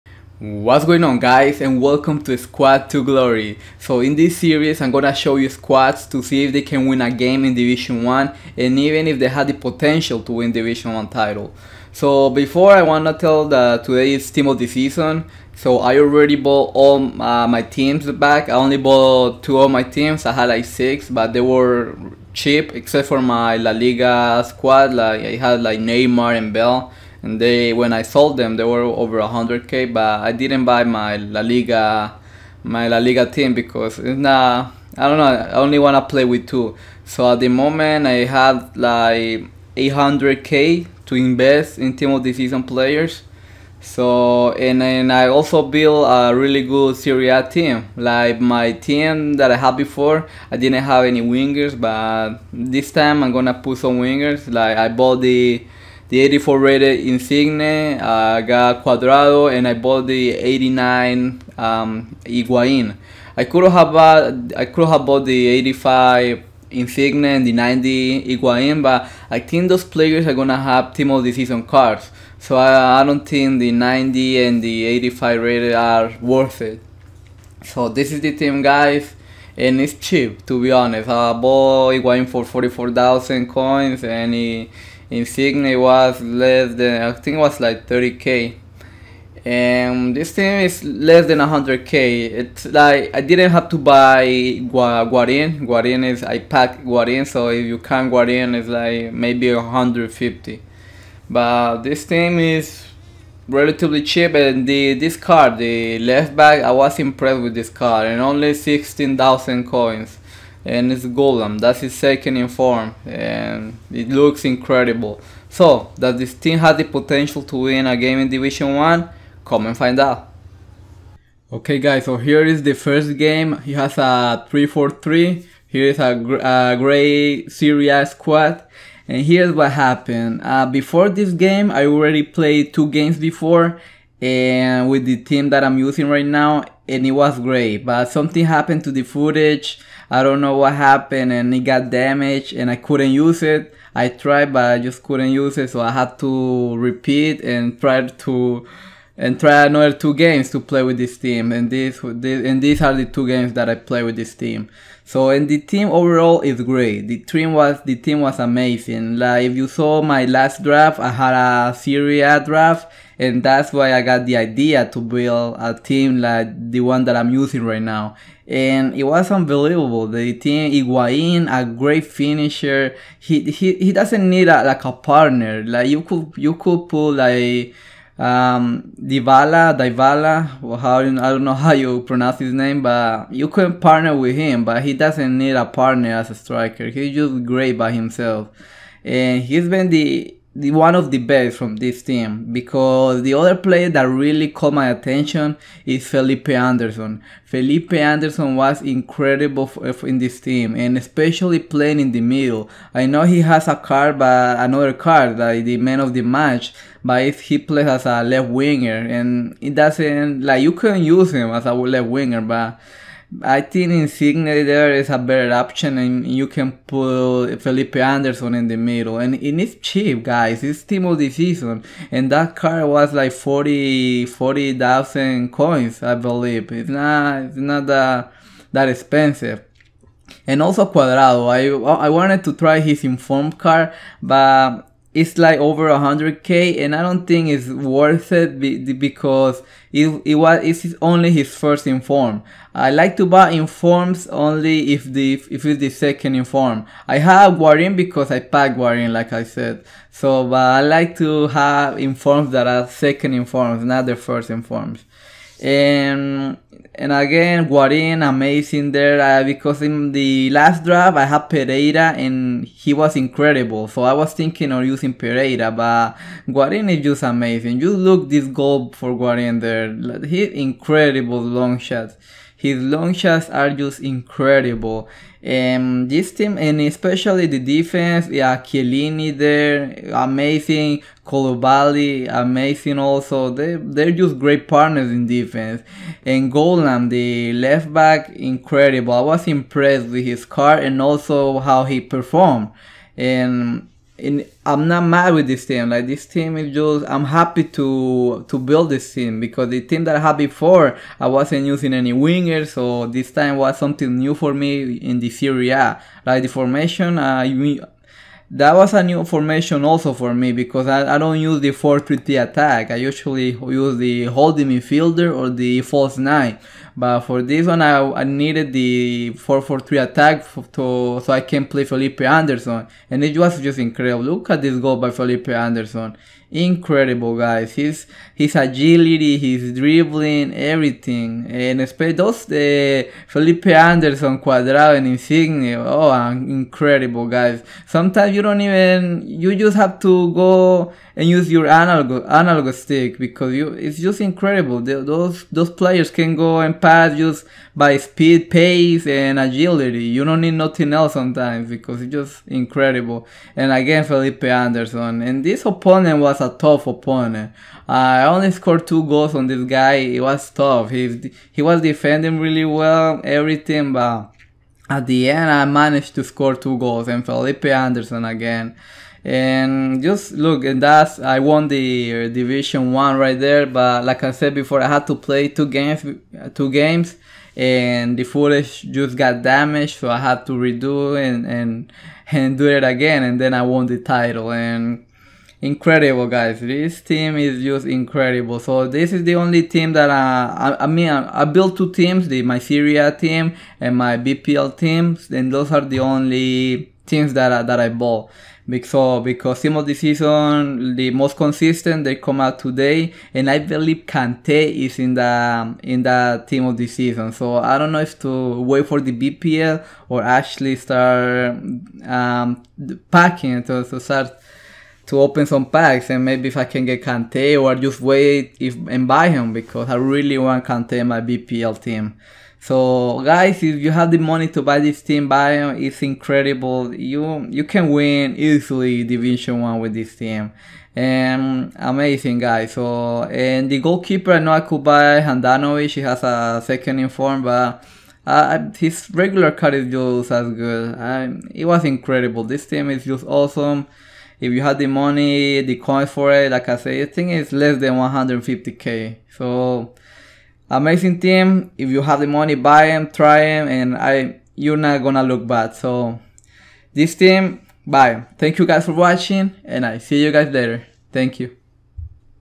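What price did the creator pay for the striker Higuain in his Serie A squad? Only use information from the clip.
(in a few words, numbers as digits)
44,000 coins.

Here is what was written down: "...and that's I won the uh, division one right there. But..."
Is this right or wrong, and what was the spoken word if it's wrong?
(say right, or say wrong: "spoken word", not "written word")
right.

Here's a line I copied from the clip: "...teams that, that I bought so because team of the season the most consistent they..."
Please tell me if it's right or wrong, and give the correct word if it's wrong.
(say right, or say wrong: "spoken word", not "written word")
right.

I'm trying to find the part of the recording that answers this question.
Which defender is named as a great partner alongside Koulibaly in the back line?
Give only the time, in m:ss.
4:38.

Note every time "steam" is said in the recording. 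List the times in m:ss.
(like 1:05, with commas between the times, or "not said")
not said.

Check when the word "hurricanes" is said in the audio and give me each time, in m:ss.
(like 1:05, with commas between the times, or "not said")
not said.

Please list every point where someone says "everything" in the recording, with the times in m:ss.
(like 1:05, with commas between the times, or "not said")
5:30, 6:03.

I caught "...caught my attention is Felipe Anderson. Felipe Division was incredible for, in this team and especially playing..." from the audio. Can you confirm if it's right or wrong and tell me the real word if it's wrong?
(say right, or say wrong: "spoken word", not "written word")
wrong: "Anderson", not "Division".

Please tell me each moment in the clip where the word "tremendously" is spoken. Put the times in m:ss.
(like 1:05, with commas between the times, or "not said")
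not said.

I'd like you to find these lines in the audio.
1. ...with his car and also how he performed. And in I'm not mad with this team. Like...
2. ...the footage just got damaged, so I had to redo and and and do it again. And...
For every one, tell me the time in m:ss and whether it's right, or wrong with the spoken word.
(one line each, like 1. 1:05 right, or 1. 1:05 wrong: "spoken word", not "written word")
1. 4:50 right
2. 6:18 right.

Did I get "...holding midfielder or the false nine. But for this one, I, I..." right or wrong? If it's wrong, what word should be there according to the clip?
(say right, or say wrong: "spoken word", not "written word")
right.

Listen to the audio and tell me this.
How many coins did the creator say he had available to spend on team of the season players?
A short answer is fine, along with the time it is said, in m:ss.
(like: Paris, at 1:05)
800k, at 0:39.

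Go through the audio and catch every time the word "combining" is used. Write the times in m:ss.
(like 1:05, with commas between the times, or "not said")
not said.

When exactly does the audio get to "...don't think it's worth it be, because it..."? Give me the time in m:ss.
3:57.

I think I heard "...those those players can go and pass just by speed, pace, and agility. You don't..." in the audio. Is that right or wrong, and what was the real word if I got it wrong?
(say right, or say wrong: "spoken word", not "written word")
right.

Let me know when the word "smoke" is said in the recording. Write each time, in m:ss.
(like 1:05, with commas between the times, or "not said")
not said.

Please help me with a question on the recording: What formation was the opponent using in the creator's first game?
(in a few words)
3-4-3.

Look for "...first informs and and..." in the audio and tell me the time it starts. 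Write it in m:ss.
4:14.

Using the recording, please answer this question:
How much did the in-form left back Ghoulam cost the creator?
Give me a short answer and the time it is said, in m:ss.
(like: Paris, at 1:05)
16,000 coins, at 1:48.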